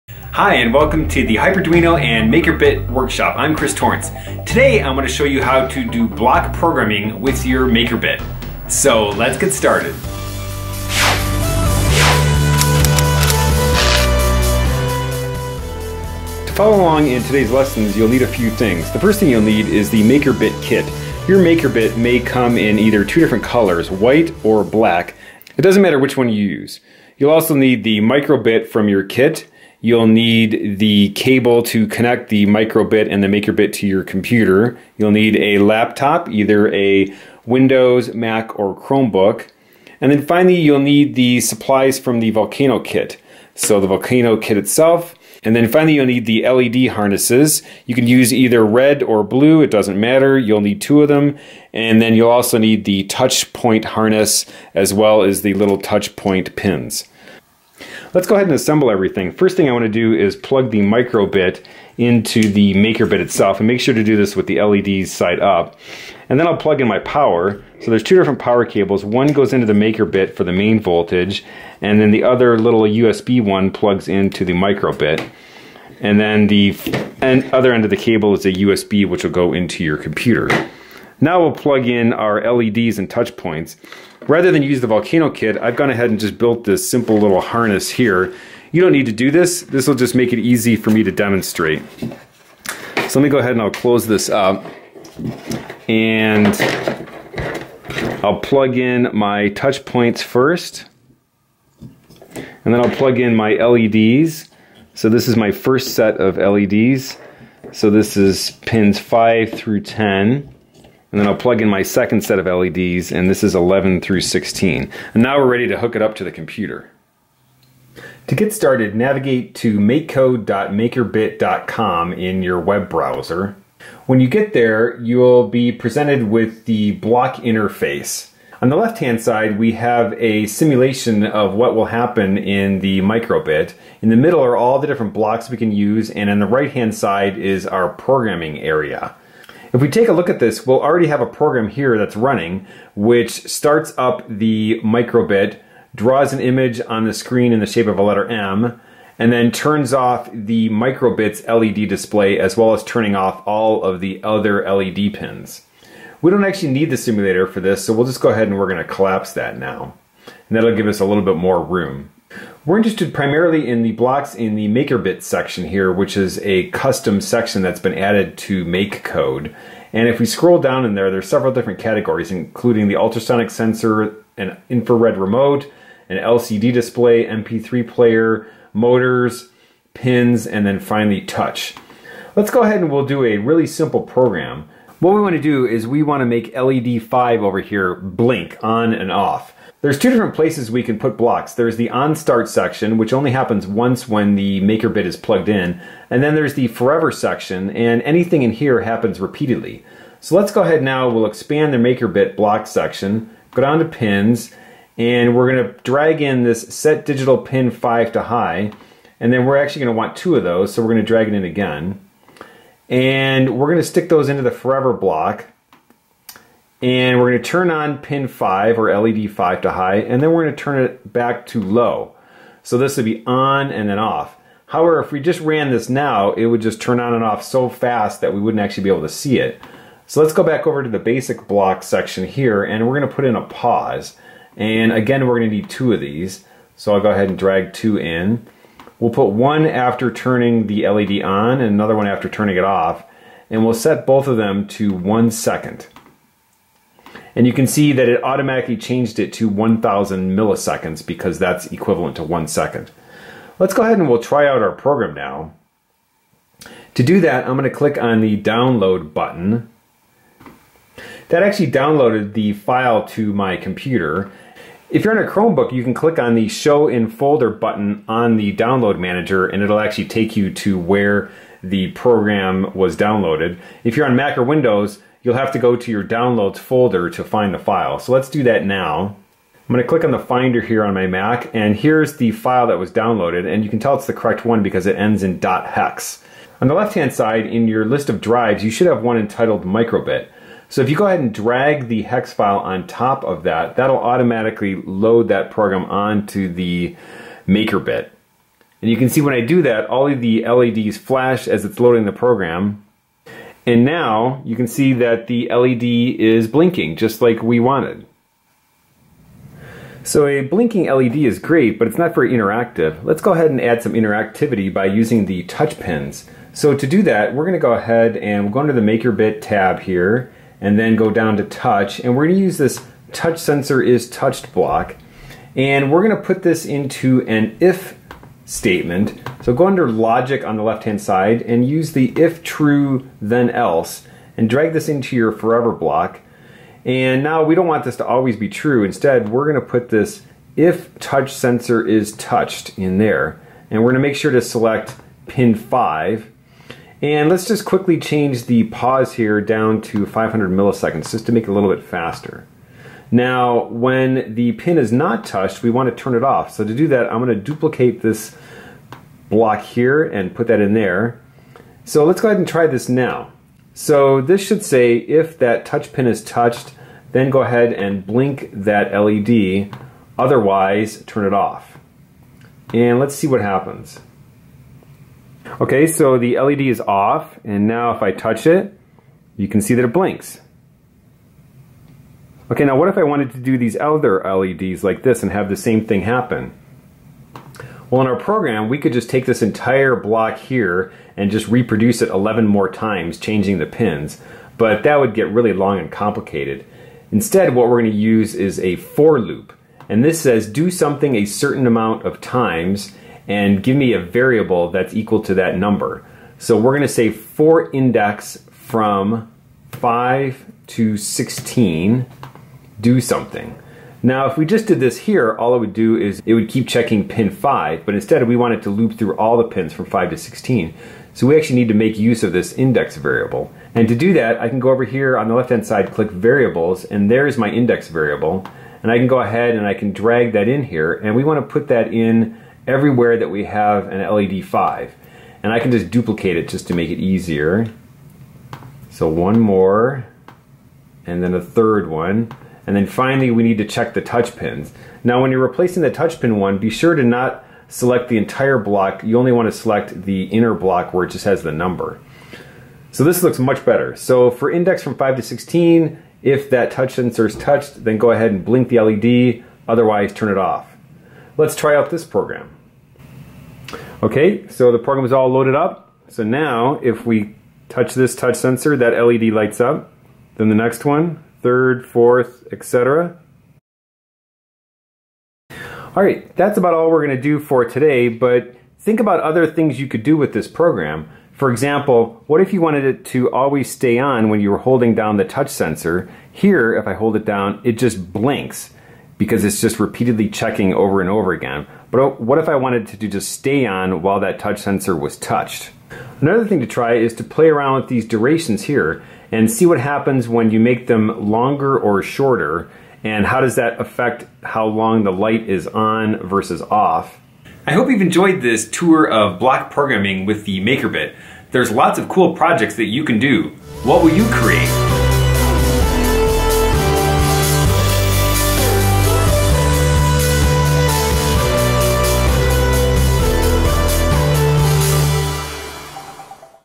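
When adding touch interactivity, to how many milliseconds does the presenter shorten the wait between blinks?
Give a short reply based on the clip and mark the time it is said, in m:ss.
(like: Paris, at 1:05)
500, at 5:50.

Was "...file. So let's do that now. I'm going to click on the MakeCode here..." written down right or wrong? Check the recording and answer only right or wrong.
wrong.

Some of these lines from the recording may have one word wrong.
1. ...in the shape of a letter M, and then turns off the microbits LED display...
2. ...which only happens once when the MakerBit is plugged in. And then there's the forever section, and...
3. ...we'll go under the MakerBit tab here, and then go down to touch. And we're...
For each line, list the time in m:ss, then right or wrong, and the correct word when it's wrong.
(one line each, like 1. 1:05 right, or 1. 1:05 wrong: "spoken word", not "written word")
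1. 2:27 right
2. 3:12 right
3. 5:18 right.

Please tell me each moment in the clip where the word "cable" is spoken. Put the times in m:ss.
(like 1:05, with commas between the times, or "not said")
0:31, 1:08, 1:17.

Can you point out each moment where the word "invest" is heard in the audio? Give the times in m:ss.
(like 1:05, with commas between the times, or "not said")
not said.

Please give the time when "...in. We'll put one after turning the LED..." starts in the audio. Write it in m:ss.
3:57.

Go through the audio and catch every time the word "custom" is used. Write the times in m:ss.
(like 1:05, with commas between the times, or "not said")
2:46.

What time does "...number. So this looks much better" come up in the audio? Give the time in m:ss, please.
7:31.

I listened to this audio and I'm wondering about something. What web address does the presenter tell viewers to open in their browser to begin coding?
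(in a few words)
makecode.makerbit.com.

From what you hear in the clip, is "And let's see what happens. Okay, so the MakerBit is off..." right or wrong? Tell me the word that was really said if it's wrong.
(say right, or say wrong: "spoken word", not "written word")
wrong: "LED", not "MakerBit".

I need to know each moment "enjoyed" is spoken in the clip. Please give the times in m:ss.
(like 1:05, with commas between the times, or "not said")
8:28.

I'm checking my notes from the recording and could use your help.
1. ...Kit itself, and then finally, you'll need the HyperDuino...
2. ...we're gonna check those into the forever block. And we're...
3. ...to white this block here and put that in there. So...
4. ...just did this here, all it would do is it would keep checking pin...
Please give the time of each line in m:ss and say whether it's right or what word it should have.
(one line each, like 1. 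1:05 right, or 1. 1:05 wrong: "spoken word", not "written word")
1. 0:44 wrong: "LED", not "HyperDuino"
2. 3:33 wrong: "stick", not "check"
3. 5:57 wrong: "duplicate", not "white"
4. 6:54 right.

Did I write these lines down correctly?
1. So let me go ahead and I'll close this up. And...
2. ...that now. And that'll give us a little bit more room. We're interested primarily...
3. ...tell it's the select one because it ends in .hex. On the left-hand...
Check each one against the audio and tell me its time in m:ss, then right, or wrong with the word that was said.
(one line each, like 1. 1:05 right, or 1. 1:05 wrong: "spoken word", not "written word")
1. 1:33 right
2. 2:39 right
3. 4:43 wrong: "correct", not "select".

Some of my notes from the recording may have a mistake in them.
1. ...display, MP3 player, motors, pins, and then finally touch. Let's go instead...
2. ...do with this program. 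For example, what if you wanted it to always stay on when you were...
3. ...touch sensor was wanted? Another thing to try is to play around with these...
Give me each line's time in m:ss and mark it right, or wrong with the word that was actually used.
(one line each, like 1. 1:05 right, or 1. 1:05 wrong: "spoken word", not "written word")
1. 2:56 wrong: "ahead", not "instead"
2. 8:00 right
3. 8:14 wrong: "touched", not "wanted".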